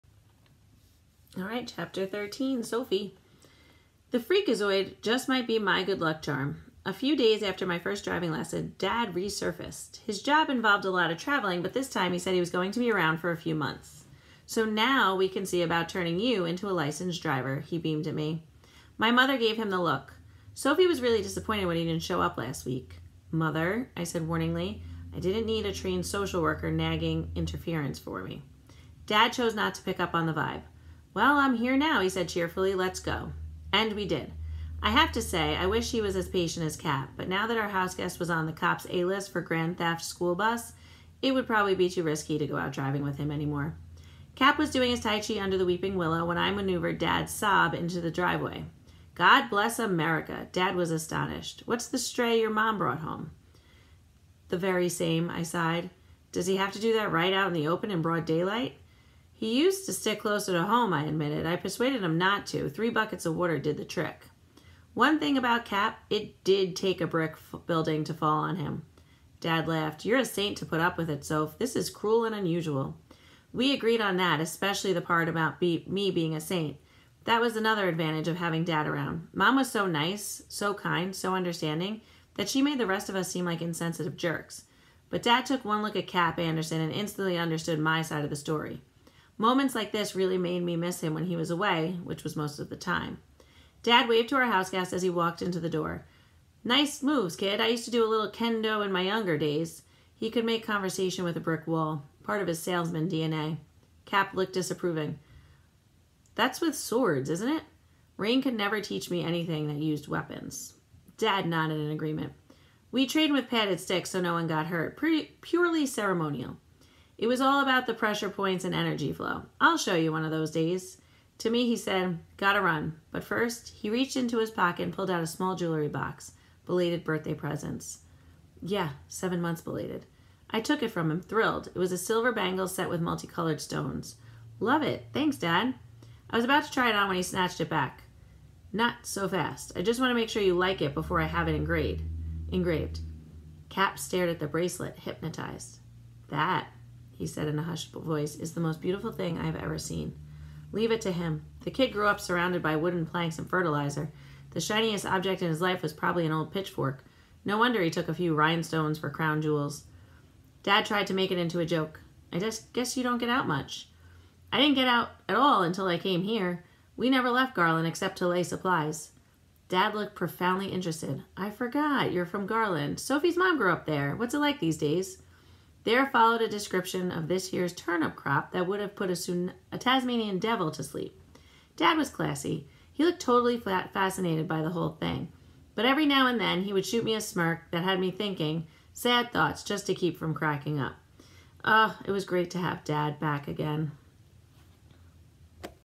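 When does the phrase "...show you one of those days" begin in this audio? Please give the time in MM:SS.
01:59.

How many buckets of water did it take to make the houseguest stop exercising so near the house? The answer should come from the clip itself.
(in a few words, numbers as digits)
3.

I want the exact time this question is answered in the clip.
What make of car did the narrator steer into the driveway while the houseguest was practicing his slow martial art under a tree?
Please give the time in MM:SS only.
00:47.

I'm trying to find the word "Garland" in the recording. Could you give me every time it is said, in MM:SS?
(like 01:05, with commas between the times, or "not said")
02:47, 02:52.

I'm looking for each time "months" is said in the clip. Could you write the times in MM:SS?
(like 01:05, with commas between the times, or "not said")
00:13, 02:09.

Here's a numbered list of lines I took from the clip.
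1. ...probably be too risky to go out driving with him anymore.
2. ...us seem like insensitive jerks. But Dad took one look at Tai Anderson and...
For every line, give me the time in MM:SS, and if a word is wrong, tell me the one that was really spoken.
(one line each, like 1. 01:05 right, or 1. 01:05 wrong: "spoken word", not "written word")
1. 00:41 right
2. 01:23 wrong: "Cap", not "Tai".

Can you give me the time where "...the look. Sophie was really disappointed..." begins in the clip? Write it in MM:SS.
00:19.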